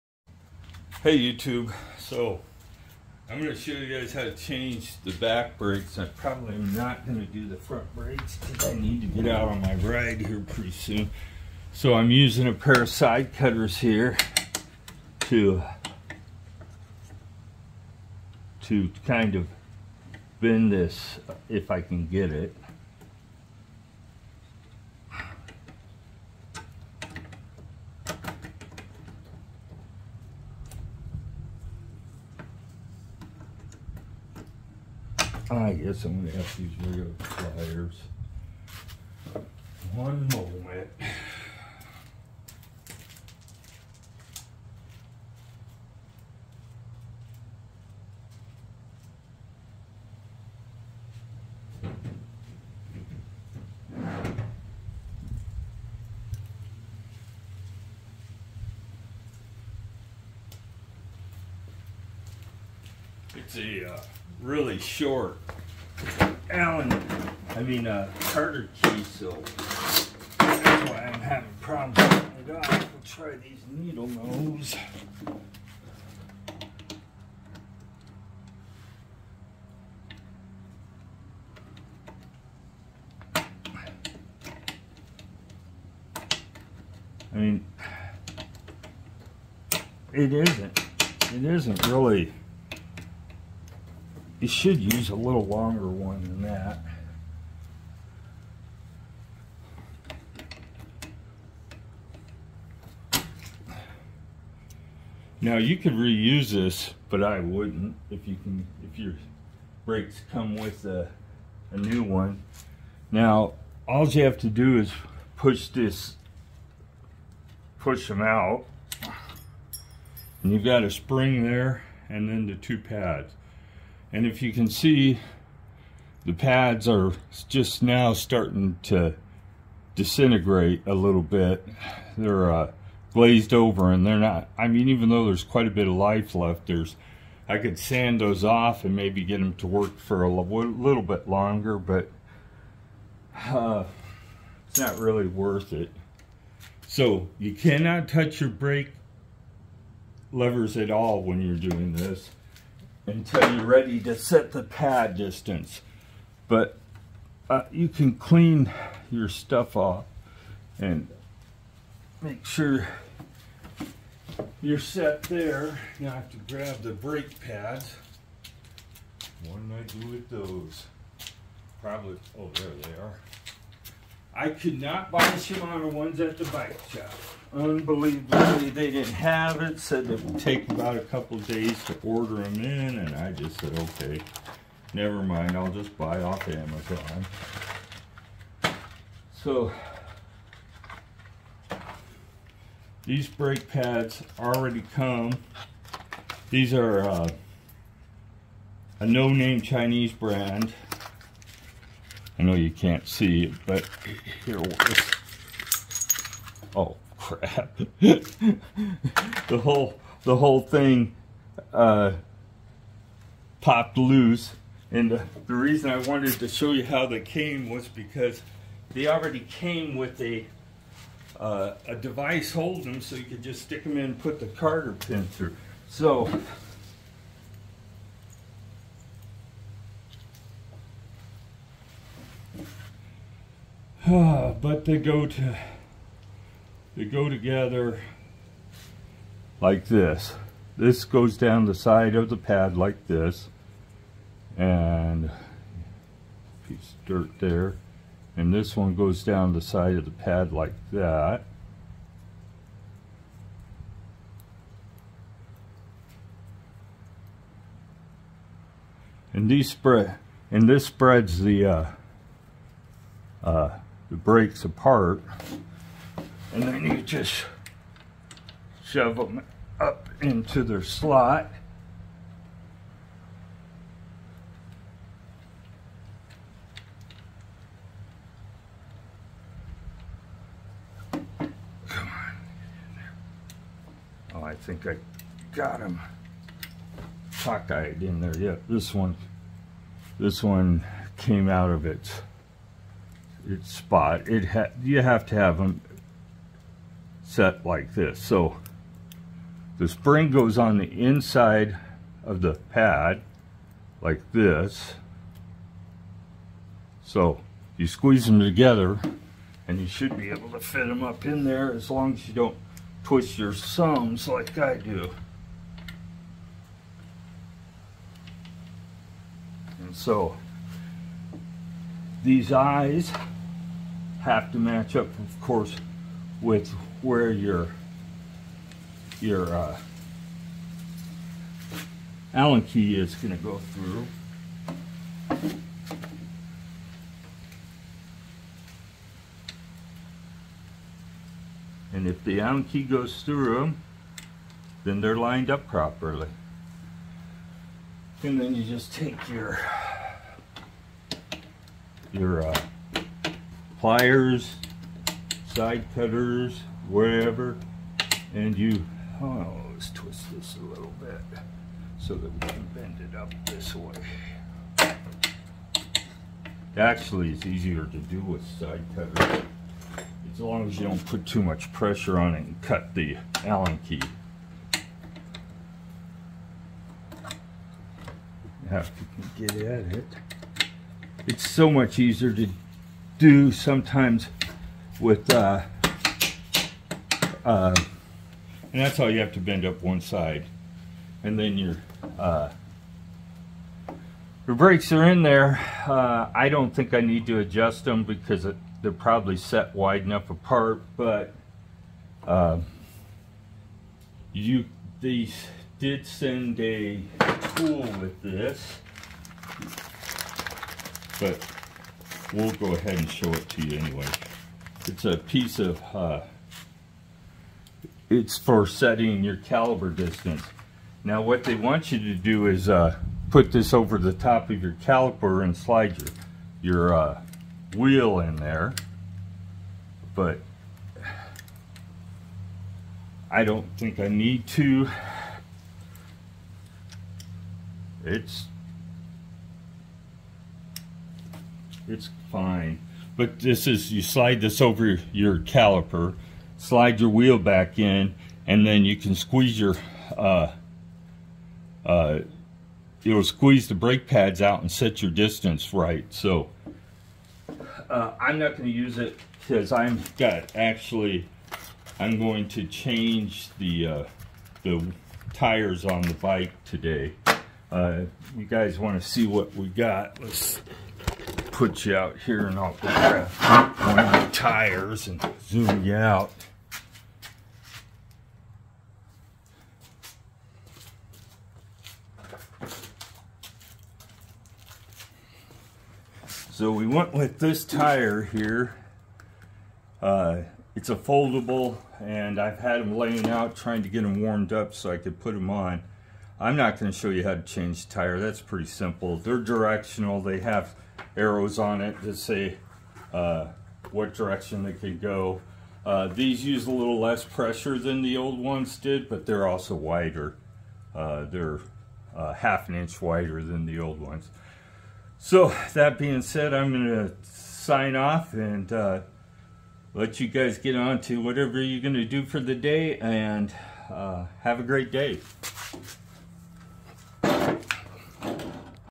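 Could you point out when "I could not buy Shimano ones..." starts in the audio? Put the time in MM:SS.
02:54.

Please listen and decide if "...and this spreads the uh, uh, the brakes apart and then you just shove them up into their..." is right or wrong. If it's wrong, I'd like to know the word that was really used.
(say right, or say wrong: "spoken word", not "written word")
right.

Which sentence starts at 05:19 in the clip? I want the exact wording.
And so these eyes have to match up, of course, with where your your uh, Allen key is going to go through.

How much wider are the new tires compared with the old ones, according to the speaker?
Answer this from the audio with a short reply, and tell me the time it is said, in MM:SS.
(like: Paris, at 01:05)
half an inch, at 08:32.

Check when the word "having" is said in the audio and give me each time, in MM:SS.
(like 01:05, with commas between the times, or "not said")
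01:11.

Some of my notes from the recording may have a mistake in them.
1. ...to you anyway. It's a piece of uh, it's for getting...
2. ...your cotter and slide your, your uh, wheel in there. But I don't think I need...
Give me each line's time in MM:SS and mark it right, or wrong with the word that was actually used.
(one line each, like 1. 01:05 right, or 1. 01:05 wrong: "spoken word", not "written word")
1. 06:53 wrong: "setting", not "getting"
2. 07:04 wrong: "caliper", not "cotter".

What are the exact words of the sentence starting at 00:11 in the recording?
So I'm using a pair of side cutters here to, to kind of bend this uh, if I can get it.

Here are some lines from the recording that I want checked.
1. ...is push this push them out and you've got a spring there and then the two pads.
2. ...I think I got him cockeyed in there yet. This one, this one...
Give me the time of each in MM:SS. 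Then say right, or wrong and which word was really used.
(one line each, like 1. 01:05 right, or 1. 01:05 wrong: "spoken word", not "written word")
1. 01:54 right
2. 04:44 right.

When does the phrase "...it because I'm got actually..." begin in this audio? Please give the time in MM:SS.
07:38.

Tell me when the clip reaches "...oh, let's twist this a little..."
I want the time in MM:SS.
05:59.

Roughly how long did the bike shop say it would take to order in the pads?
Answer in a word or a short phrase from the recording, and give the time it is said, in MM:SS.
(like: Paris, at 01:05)
a couple days, at 03:00.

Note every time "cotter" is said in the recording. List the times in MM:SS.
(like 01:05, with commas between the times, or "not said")
01:08, 03:44.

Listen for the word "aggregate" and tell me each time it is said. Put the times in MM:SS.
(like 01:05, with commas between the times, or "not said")
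not said.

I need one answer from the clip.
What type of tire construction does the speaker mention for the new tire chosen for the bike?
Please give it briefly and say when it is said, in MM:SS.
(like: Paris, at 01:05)
foldable, at 08:10.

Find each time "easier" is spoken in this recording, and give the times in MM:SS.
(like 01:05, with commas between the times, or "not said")
06:07, 06:21.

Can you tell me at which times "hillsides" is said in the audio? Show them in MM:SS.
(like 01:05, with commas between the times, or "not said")
not said.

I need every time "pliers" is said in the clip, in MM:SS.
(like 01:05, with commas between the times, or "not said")
00:37, 05:53.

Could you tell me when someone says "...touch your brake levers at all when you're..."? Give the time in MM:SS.
02:28.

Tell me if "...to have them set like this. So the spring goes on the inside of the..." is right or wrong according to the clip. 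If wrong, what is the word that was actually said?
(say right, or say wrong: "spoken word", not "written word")
right.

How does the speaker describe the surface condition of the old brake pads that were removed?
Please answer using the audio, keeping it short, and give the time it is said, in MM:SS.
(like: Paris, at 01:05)
glazed over, at 02:13.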